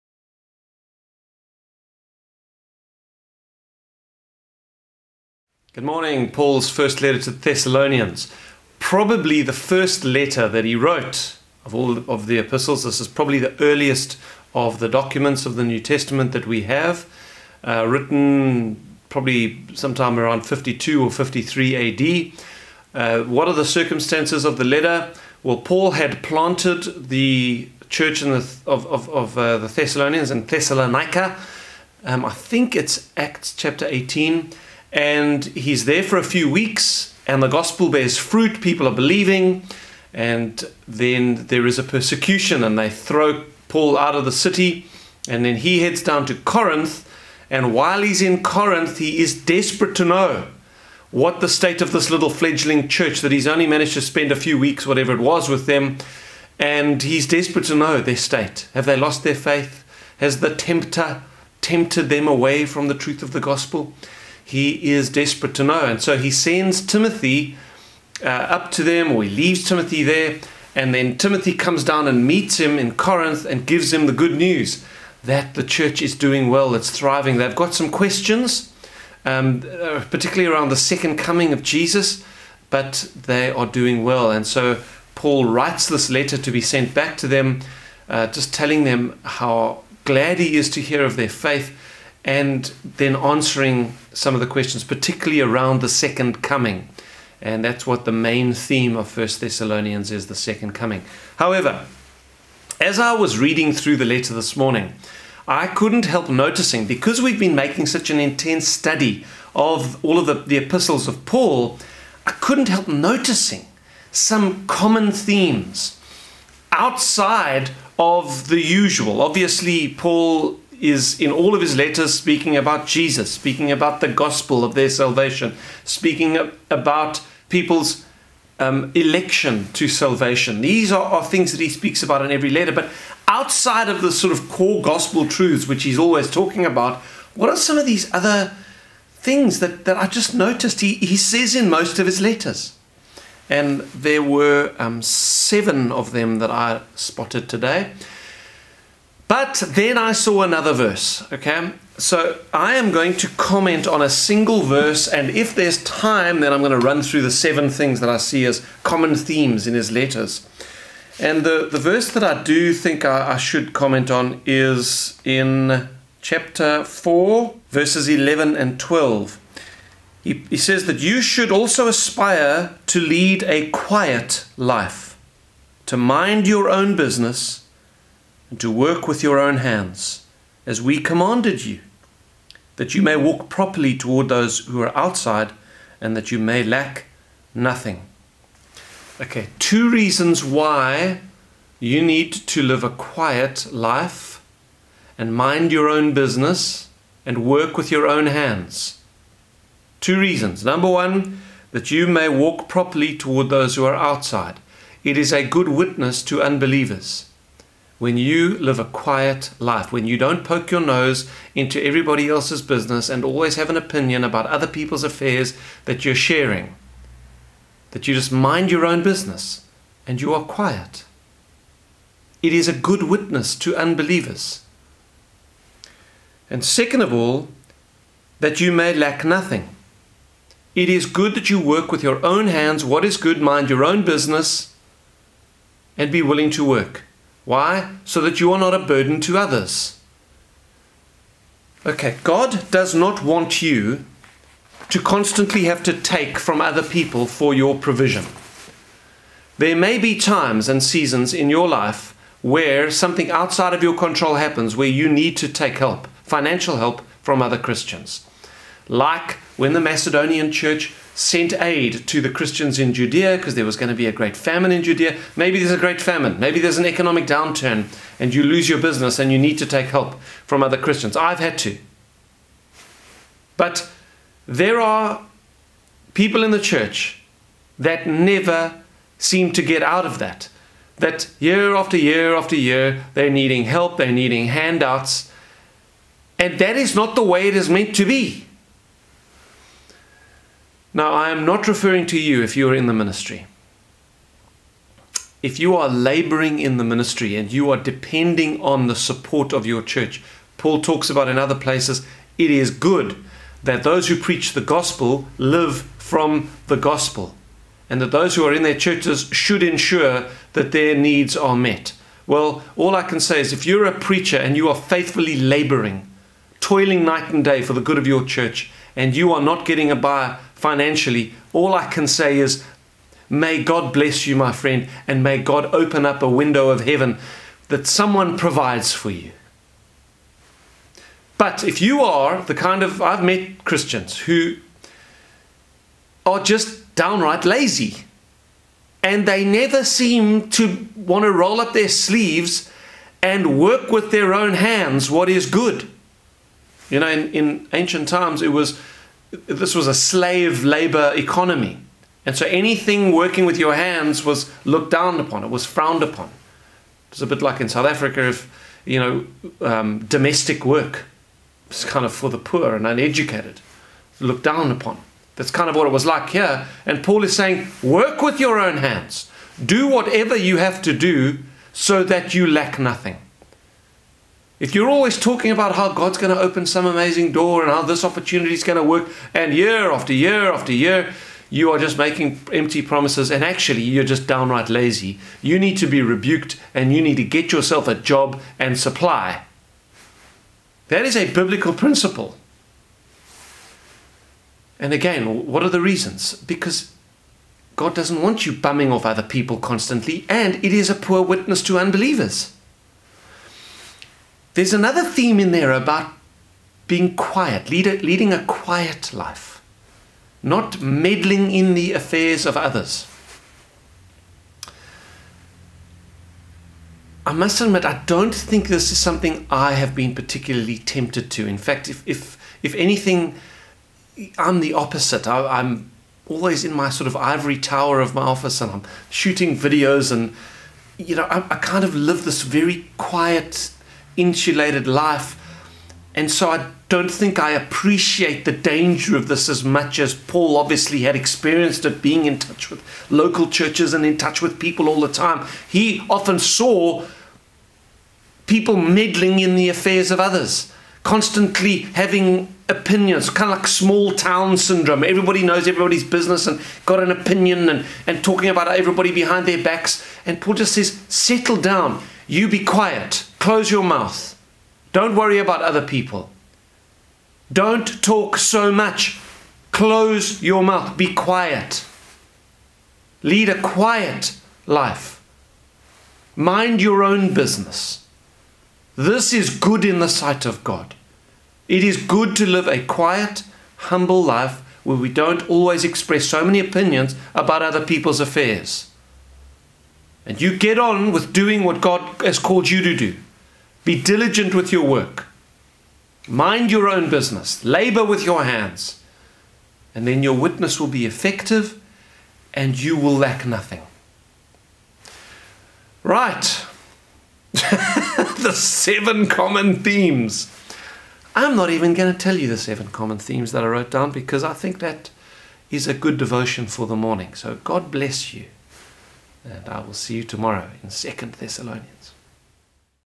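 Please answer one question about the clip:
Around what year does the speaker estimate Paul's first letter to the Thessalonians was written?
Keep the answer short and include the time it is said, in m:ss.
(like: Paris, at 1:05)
52 or 53 AD, at 0:20.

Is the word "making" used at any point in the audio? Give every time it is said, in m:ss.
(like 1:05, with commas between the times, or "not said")
1:47, 6:21.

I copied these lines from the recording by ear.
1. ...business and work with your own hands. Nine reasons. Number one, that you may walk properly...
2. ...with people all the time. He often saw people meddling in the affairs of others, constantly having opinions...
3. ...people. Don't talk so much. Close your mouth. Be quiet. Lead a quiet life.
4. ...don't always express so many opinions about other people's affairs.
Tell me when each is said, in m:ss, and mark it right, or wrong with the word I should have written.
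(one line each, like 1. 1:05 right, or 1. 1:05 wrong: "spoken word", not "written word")
1. 3:16 wrong: "Two", not "Nine"
2. 7:24 right
3. 7:45 right
4. 8:05 right.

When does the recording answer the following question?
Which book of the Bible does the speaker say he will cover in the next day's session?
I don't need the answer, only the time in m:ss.
8:40.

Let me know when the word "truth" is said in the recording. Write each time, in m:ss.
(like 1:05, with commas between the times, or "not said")
1:02, 2:15.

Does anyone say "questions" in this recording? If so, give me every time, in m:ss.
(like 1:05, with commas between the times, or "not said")
1:17, 1:34.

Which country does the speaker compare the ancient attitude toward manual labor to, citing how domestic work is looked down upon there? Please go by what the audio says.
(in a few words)
South Africa.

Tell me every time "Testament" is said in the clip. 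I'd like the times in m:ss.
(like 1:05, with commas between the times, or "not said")
0:15.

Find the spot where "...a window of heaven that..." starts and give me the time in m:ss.
5:26.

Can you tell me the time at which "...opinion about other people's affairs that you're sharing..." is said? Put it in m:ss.
3:33.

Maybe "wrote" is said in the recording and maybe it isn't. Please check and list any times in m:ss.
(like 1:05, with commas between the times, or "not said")
0:10, 8:33.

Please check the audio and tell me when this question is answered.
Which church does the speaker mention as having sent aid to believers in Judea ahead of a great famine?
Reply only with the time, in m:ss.
4:19.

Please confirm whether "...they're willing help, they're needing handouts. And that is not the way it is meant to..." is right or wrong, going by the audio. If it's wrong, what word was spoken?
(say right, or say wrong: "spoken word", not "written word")
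wrong: "needing", not "willing".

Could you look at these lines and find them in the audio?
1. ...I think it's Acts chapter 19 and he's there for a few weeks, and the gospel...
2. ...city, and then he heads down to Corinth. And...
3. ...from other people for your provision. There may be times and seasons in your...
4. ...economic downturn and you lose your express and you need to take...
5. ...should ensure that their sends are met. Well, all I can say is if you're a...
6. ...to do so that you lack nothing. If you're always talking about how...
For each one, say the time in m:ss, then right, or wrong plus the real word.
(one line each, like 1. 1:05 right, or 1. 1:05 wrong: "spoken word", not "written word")
1. 0:32 wrong: "18", not "19"
2. 0:44 right
3. 4:06 right
4. 4:26 wrong: "business", not "express"
5. 5:09 wrong: "needs", not "sends"
6. 6:10 right.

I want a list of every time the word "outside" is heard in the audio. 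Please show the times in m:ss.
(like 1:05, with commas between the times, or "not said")
1:56, 2:13, 3:04, 3:23, 4:13.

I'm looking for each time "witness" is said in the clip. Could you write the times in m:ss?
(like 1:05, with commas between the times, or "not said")
3:25, 3:43, 6:41, 8:20.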